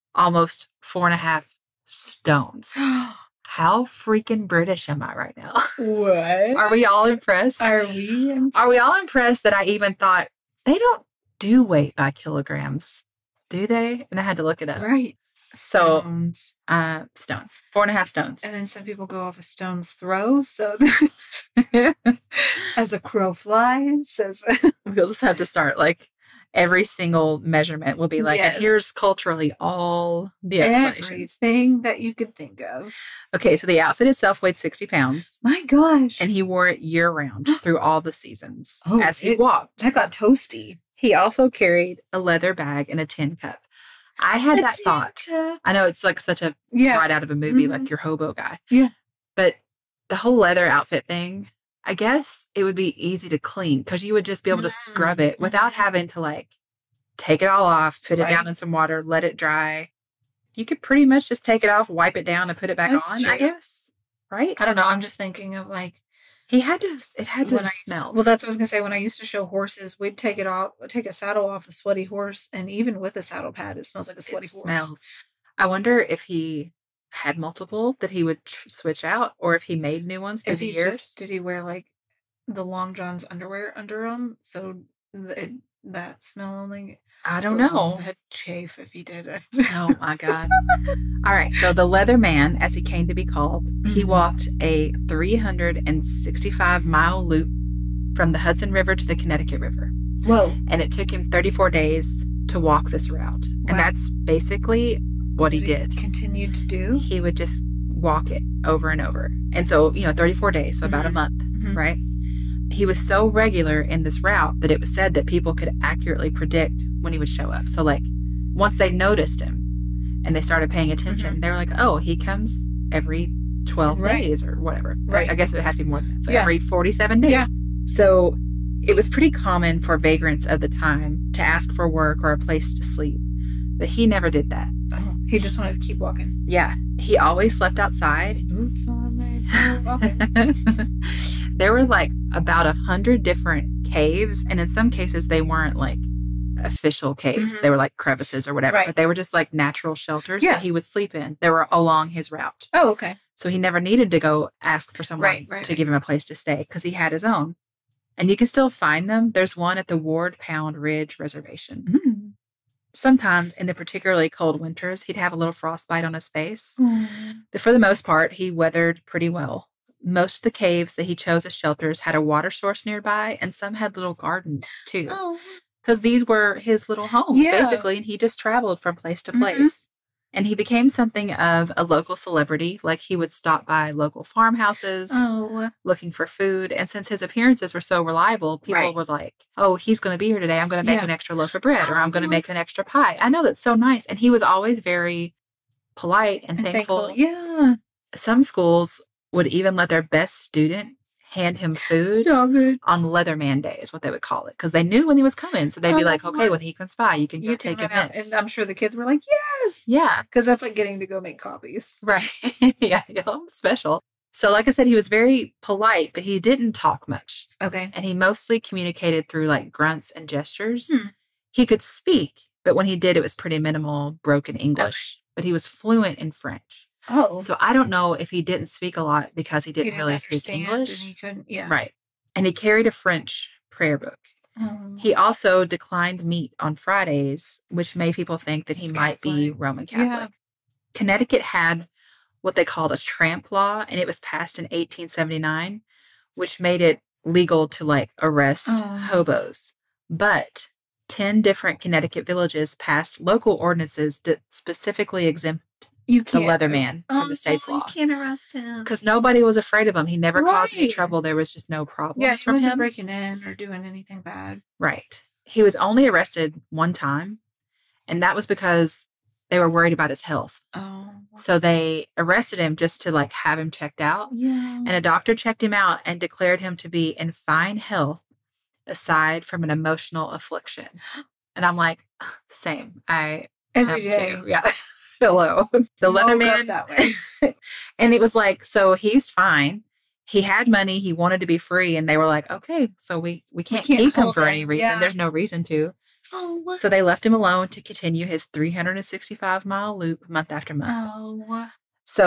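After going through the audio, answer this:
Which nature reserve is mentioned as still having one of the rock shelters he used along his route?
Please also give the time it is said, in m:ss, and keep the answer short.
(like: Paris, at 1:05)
Ward Pound Ridge Reservation, at 2:39.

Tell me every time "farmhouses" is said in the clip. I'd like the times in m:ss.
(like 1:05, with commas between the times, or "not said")
3:04.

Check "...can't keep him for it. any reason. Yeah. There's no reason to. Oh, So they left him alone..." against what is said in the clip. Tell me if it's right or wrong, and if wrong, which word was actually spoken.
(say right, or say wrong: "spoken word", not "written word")
right.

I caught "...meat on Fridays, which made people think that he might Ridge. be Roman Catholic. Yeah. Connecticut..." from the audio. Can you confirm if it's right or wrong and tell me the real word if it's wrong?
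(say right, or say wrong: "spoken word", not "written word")
wrong: "Catholic", not "Ridge".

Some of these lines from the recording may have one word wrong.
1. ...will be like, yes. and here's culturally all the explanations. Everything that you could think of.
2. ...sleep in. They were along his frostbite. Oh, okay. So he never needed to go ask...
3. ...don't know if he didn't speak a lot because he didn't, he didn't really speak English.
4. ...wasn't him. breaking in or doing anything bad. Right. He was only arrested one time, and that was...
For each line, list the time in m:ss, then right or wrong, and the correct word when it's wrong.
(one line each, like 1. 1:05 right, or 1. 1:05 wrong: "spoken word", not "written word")
1. 0:27 right
2. 2:30 wrong: "route", not "frostbite"
3. 3:47 right
4. 4:22 right.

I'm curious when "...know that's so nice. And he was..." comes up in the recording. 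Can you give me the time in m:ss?
3:13.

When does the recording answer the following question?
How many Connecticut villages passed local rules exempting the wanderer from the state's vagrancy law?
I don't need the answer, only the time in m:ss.
4:11.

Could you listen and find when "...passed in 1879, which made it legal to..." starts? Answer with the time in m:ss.
4:04.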